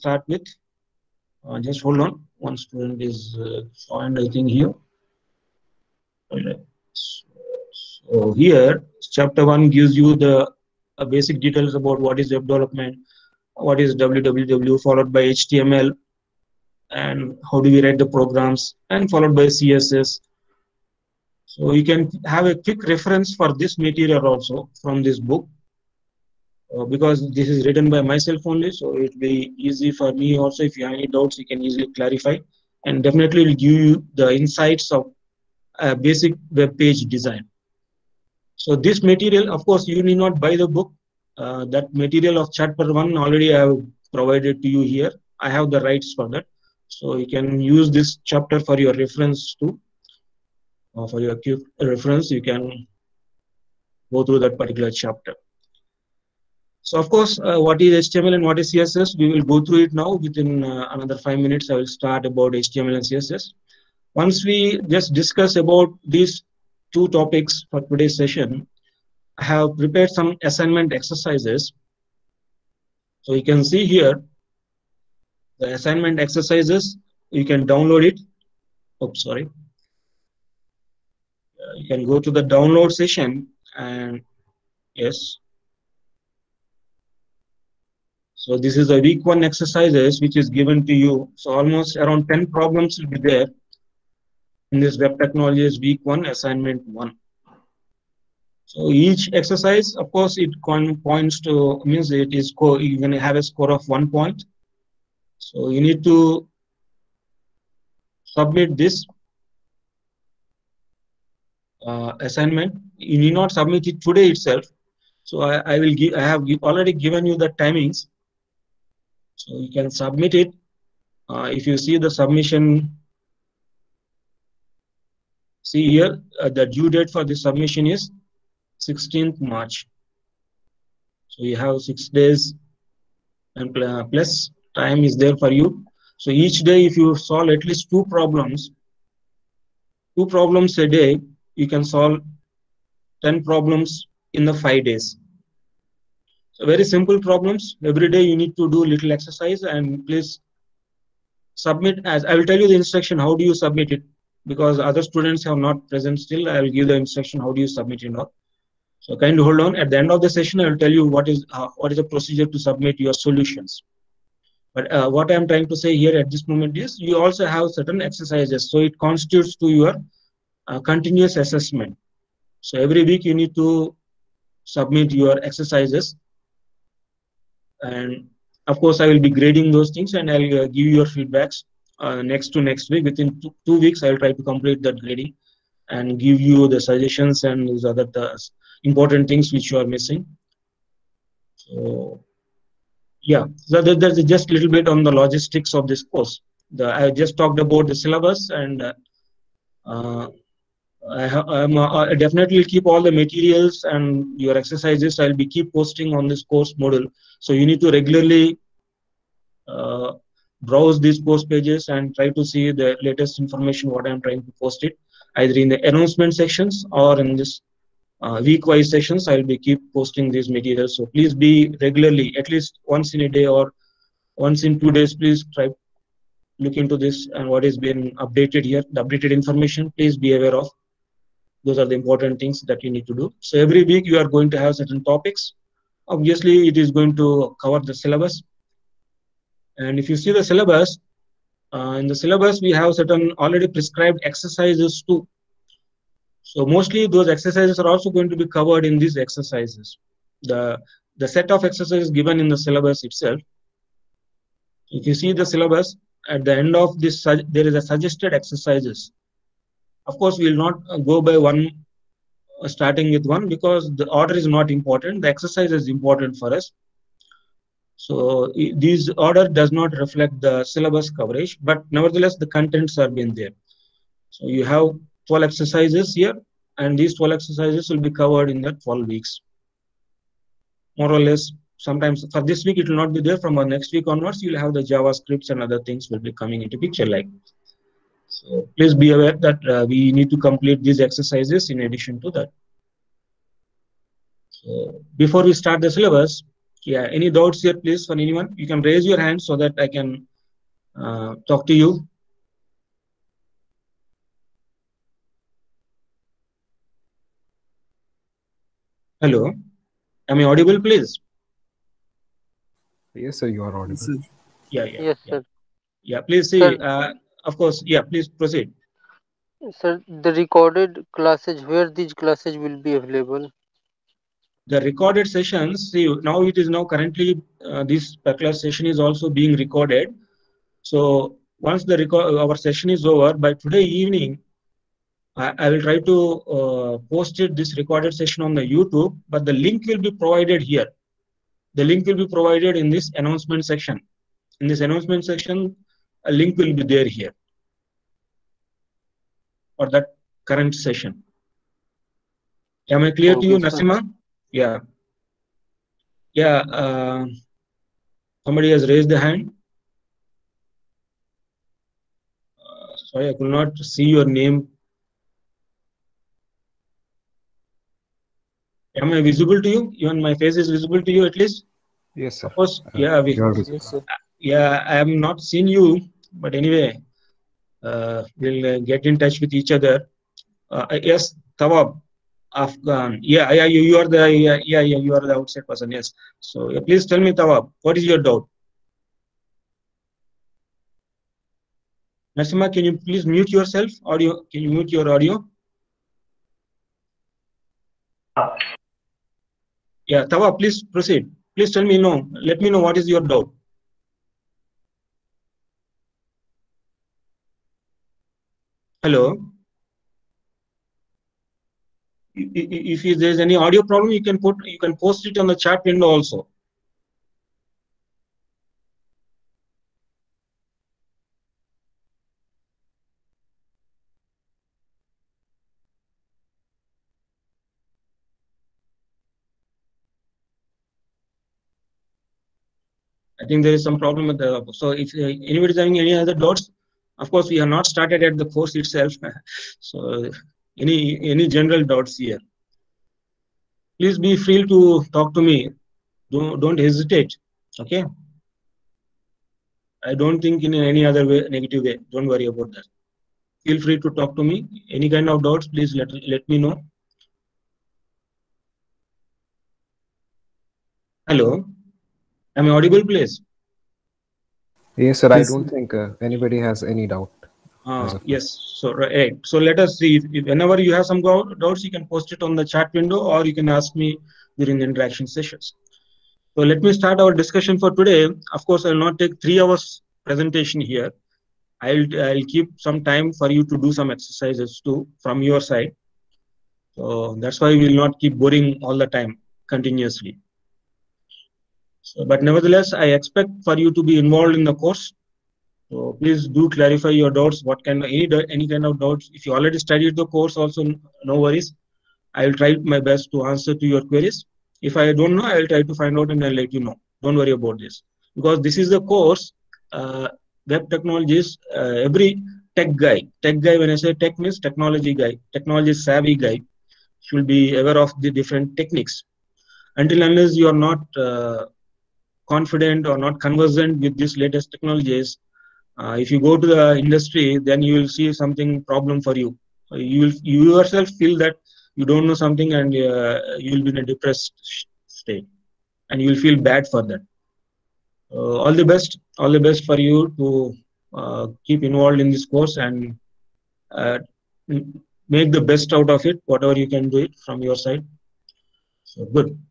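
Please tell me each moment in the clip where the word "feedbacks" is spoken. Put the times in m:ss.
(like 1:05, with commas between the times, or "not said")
3:01.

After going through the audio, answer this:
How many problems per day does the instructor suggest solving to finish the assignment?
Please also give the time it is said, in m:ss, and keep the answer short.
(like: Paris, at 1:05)
2, at 2:20.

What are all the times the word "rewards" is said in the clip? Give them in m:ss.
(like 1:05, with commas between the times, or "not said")
not said.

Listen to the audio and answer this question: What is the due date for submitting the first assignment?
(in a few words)
16th March.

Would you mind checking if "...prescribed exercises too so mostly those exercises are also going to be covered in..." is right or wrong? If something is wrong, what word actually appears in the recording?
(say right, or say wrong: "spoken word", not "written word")
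right.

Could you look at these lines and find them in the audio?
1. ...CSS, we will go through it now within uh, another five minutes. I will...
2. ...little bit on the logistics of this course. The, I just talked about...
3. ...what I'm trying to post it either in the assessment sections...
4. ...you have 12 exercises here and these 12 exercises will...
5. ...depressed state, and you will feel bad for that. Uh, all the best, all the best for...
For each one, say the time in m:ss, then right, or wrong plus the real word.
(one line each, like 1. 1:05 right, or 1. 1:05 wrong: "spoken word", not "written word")
1. 0:58 right
2. 3:14 right
3. 3:33 wrong: "announcement", not "assessment"
4. 4:34 right
5. 8:54 right.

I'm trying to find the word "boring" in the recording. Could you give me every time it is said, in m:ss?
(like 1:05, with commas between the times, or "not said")
8:08.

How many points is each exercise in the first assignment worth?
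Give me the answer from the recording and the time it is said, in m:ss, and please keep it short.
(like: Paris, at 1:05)
1, at 1:43.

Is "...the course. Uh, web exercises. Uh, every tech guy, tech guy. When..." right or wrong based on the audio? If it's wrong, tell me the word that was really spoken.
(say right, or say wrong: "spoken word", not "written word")
wrong: "technologies", not "exercises".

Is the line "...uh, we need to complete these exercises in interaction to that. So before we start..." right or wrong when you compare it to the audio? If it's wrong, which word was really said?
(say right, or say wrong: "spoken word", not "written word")
wrong: "addition", not "interaction".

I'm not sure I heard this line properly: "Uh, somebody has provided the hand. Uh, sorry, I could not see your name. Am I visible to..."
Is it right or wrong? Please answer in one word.
wrong.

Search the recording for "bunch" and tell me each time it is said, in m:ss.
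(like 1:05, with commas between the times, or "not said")
not said.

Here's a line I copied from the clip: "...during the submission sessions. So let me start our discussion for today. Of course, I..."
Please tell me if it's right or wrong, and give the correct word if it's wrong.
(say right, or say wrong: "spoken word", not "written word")
wrong: "interaction", not "submission".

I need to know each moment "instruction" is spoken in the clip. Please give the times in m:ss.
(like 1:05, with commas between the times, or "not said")
2:32, 2:37.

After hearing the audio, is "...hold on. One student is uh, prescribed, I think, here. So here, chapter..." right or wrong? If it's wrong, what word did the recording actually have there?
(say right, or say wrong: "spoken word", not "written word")
wrong: "joined", not "prescribed".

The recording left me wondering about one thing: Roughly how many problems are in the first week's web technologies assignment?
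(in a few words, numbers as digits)
10.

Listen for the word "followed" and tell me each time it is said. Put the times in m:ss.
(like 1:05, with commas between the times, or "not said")
0:14, 0:19.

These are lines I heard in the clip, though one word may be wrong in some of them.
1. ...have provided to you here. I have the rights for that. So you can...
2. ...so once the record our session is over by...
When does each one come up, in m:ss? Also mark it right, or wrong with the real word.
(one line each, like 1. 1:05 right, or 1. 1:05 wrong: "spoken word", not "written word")
1. 0:43 right
2. 5:30 right.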